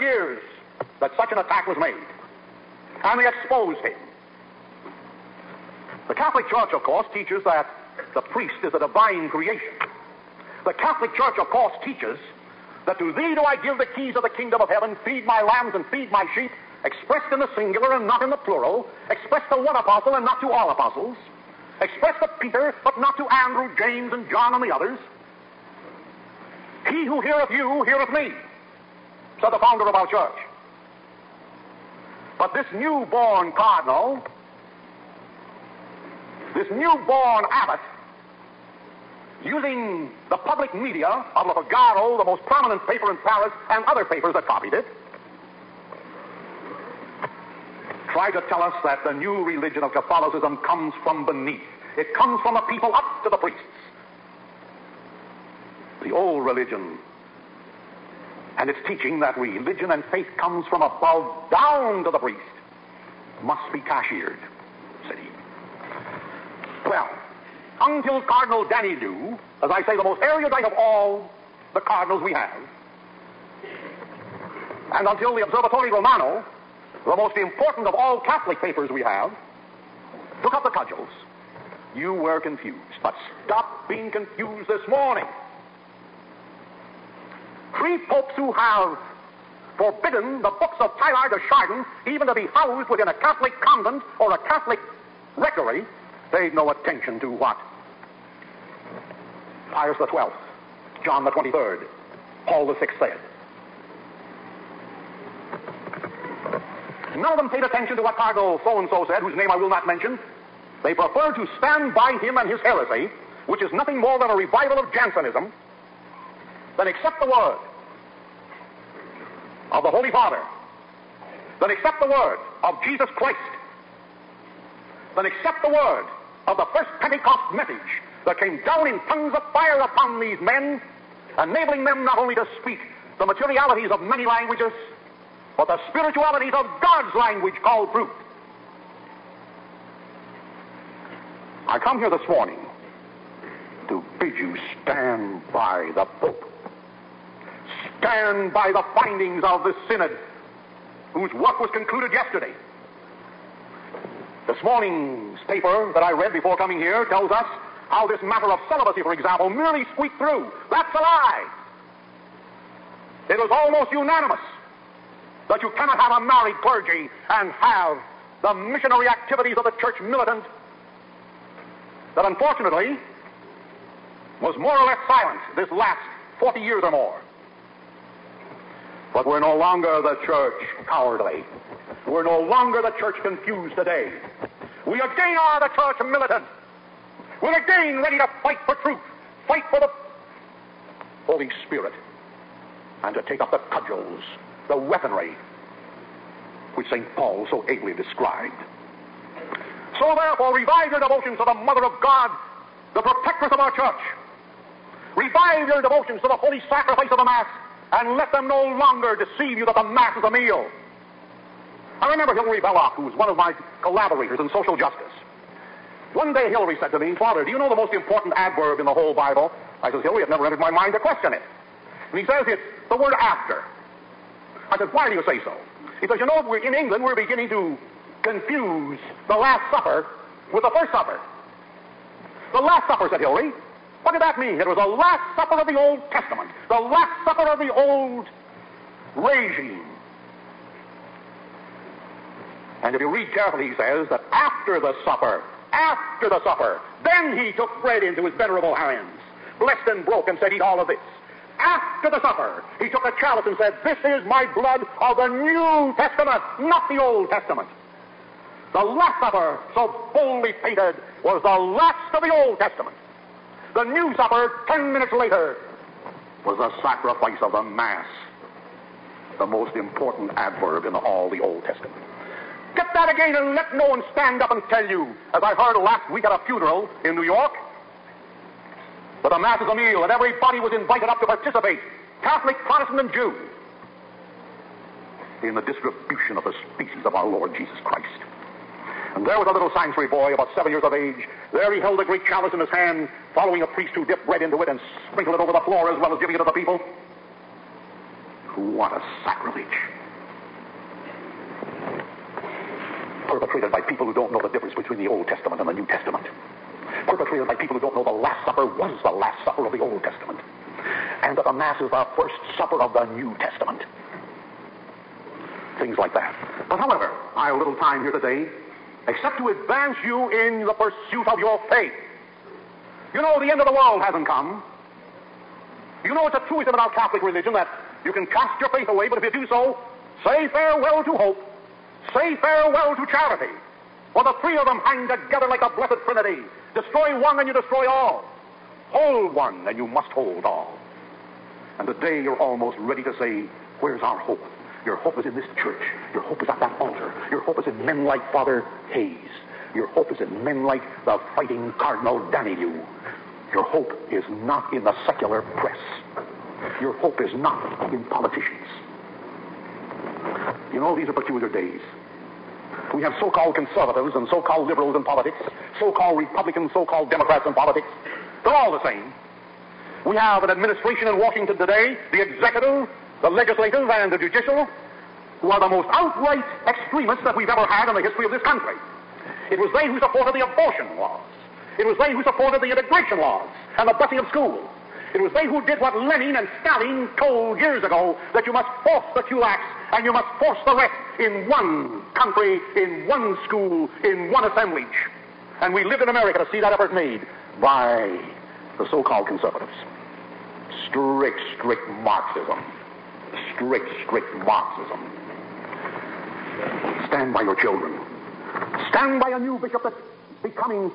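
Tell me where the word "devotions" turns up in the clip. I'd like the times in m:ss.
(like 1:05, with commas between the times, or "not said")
3:20, 3:25.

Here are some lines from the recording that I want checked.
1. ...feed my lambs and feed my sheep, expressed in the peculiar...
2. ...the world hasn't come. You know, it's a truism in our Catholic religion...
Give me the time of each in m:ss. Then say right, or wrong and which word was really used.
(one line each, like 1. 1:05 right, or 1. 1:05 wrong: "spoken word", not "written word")
1. 0:15 wrong: "singular", not "peculiar"
2. 5:23 right.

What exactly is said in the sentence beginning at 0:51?
It comes from the people up to the priests.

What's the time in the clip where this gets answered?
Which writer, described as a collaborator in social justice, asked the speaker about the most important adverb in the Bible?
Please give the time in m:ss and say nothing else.
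3:32.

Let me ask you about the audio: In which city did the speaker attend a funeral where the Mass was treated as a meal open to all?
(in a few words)
New York.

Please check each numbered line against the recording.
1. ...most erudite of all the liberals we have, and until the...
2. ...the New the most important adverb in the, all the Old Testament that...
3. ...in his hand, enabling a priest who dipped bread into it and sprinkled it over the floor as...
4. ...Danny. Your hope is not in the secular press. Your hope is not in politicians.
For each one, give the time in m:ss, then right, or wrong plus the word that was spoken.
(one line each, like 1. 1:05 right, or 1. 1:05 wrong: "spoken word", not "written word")
1. 1:10 wrong: "cardinals", not "liberals"
2. 4:27 wrong: "Mass", not "New"
3. 4:52 wrong: "following", not "enabling"
4. 5:52 right.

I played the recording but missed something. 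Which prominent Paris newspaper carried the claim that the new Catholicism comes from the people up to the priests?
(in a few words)
Le Figaro.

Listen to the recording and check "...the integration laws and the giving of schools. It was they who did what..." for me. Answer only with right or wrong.
wrong.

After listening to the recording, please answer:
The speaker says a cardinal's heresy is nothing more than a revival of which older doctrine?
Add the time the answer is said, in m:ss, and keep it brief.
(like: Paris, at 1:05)
Jansenism, at 1:54.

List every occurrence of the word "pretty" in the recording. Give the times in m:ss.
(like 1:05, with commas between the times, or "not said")
not said.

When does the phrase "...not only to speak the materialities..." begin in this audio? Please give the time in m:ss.
2:12.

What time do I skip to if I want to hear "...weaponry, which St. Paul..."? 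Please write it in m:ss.
3:14.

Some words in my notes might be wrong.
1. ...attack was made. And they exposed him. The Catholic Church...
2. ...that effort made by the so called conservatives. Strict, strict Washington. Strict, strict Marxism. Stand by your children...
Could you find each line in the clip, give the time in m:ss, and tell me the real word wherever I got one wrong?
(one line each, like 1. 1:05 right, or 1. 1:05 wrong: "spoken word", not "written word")
1. 0:01 right
2. 6:36 wrong: "Marxism", not "Washington".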